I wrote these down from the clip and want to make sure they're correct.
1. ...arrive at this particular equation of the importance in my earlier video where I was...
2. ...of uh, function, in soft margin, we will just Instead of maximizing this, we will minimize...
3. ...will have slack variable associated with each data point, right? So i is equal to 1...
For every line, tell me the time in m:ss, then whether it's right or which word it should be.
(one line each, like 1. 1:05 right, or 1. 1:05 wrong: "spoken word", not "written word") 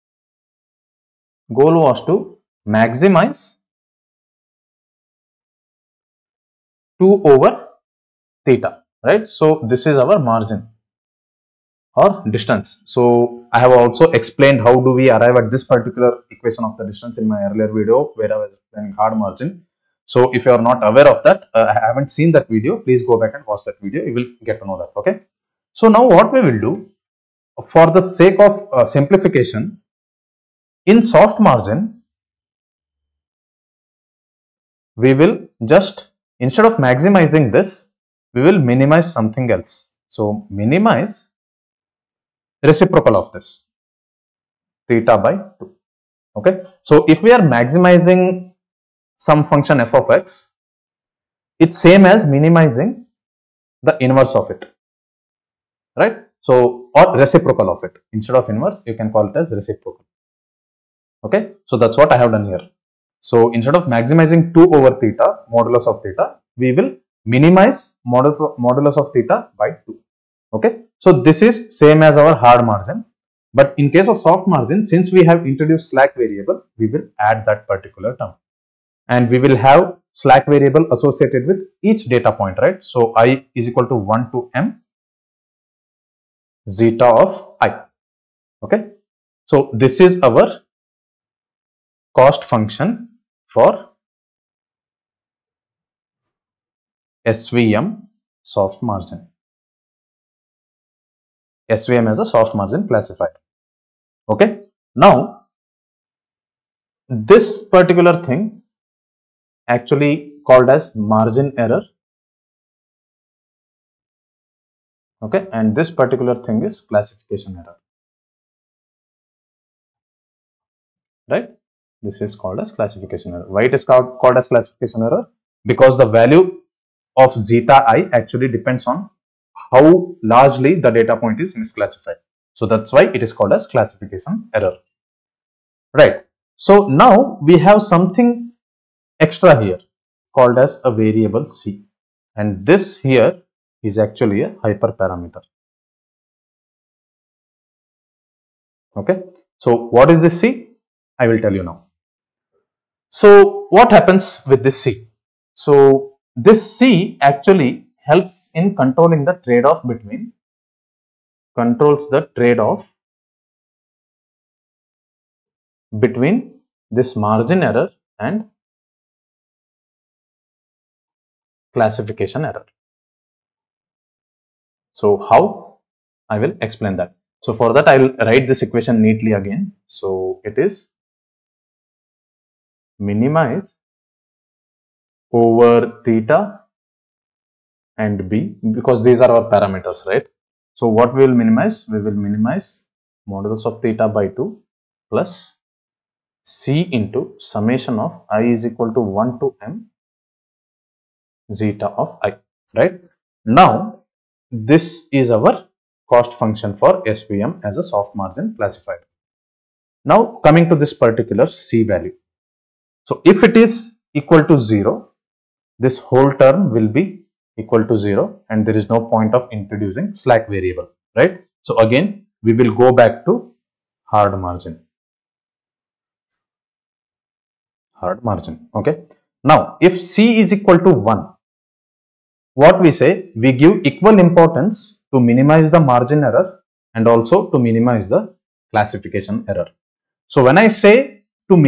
1. 0:15 wrong: "distance", not "importance"
2. 0:28 wrong: "simplification", not "function"
3. 1:19 right.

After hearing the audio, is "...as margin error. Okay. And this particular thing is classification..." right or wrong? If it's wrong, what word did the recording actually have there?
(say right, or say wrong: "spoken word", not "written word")
right.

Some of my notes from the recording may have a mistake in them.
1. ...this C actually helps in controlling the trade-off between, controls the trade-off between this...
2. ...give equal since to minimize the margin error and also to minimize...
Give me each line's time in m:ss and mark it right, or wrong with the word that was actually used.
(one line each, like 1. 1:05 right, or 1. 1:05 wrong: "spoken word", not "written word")
1. 2:36 right
2. 3:53 wrong: "importance", not "since".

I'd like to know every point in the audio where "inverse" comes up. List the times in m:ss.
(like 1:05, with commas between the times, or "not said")
0:54, 0:58.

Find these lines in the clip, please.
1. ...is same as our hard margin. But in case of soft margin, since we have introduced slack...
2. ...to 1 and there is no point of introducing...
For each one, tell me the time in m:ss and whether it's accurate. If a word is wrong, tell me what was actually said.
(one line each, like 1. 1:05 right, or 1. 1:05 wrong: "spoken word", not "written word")
1. 1:11 right
2. 3:37 wrong: "0", not "1".